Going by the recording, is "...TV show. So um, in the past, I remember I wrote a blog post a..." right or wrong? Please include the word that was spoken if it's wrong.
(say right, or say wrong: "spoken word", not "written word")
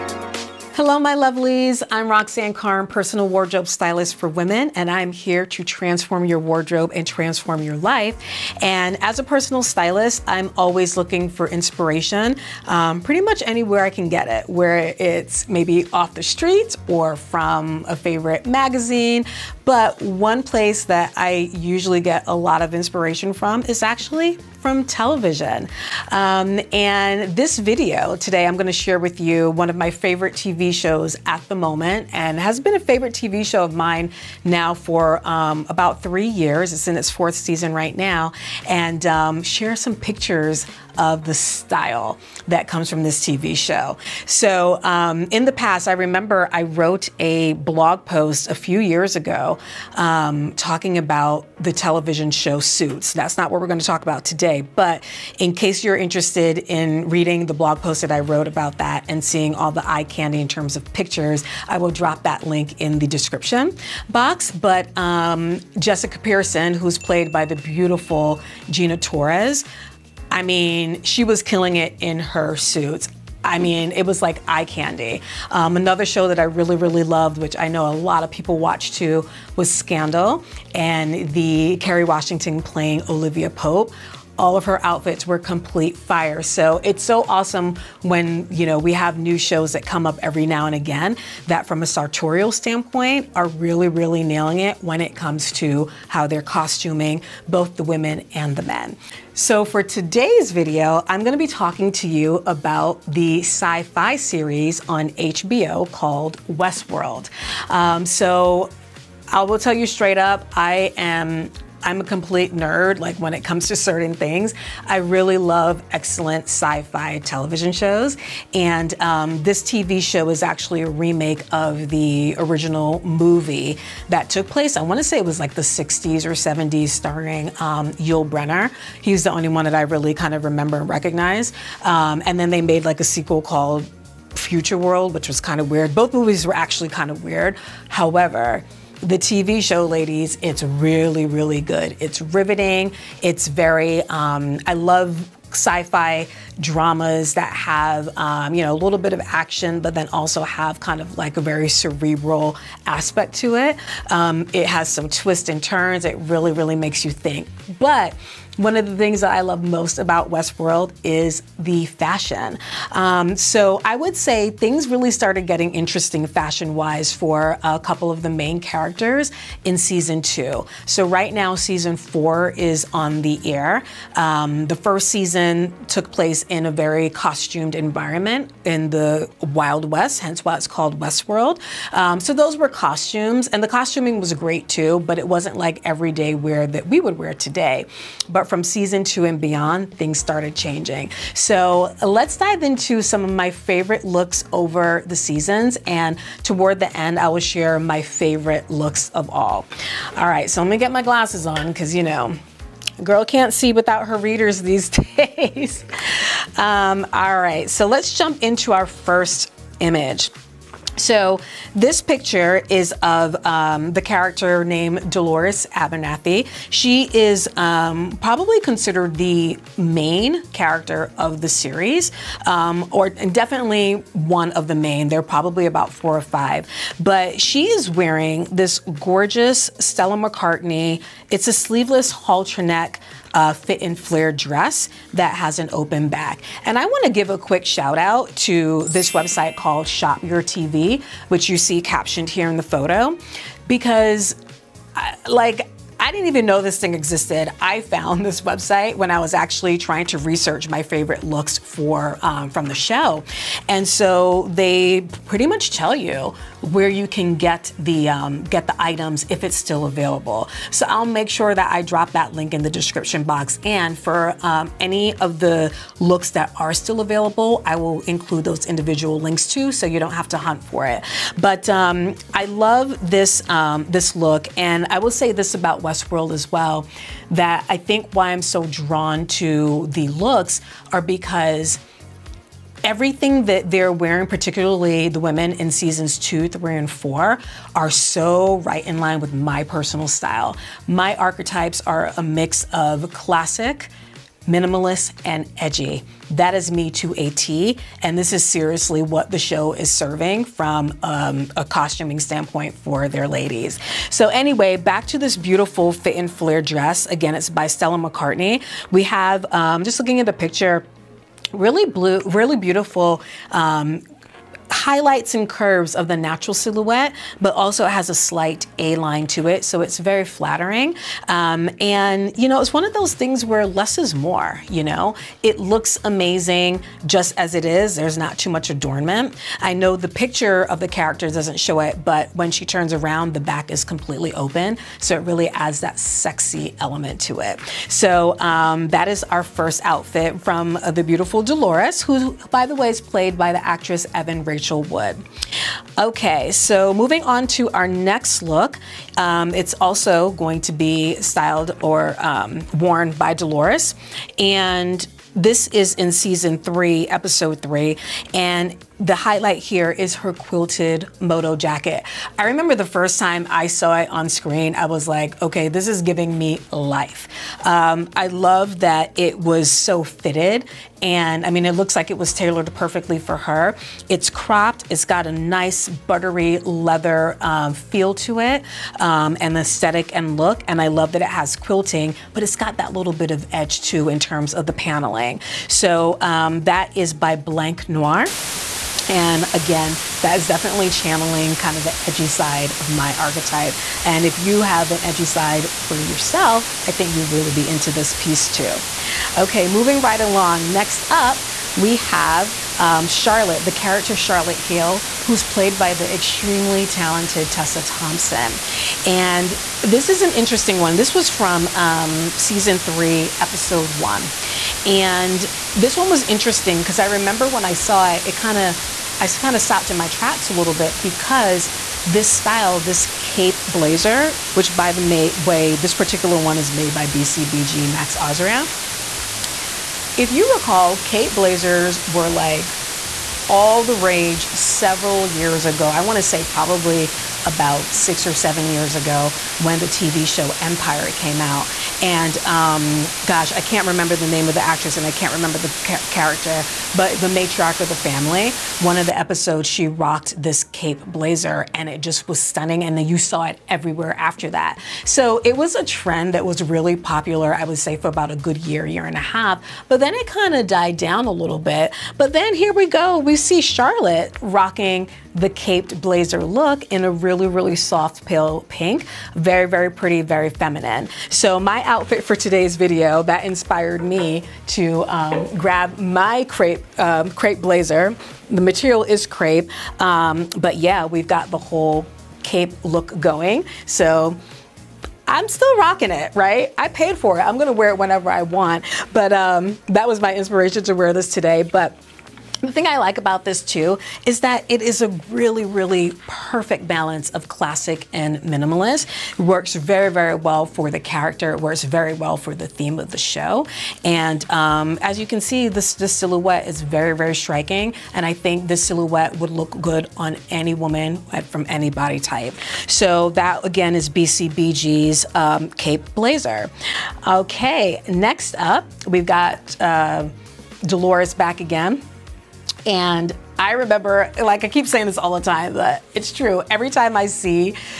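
right.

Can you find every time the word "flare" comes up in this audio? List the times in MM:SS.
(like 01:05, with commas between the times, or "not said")
03:53, 05:06.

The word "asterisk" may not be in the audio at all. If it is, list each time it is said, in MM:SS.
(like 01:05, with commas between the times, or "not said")
not said.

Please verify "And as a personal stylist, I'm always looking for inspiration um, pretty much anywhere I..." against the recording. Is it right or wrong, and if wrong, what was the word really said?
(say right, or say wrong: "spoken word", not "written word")
right.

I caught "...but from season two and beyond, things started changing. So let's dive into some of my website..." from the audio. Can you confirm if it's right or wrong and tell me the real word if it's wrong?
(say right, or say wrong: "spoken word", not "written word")
wrong: "favorite", not "website".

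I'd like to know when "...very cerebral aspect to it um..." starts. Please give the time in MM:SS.
02:31.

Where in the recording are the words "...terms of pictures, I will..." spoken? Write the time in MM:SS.
01:00.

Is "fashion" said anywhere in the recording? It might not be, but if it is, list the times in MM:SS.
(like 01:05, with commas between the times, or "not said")
02:41, 02:46.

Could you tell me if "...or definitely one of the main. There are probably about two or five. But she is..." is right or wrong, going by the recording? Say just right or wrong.
wrong.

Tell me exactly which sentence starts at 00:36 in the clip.
It's in its fourth season right now.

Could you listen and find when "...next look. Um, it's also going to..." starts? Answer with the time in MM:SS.
05:47.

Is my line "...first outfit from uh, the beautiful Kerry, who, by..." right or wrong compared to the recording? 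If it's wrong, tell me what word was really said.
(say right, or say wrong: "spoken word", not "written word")
wrong: "Dolores", not "Kerry".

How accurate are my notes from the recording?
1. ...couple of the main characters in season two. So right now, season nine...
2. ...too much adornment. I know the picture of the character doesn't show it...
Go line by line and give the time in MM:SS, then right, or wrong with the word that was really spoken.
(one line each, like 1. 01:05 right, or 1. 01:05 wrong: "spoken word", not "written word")
1. 02:47 wrong: "four", not "nine"
2. 05:28 right.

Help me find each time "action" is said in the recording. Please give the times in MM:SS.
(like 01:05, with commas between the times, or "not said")
02:29.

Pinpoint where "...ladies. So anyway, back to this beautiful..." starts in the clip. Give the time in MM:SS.
05:03.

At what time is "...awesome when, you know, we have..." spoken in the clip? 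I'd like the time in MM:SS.
01:27.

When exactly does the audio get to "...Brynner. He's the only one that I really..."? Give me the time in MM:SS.
02:08.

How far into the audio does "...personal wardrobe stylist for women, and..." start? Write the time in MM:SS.
00:02.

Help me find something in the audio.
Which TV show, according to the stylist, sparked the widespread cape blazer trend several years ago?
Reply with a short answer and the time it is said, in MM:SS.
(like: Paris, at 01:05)
Empire, at 07:20.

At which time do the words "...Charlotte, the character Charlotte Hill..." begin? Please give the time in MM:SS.
06:43.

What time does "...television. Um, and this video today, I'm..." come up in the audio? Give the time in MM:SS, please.
00:24.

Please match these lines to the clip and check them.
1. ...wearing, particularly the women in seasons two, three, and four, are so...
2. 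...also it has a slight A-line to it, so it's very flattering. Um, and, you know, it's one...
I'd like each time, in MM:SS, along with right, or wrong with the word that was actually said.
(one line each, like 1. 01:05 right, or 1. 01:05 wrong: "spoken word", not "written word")
1. 04:43 right
2. 05:17 right.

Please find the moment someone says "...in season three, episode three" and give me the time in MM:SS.
05:55.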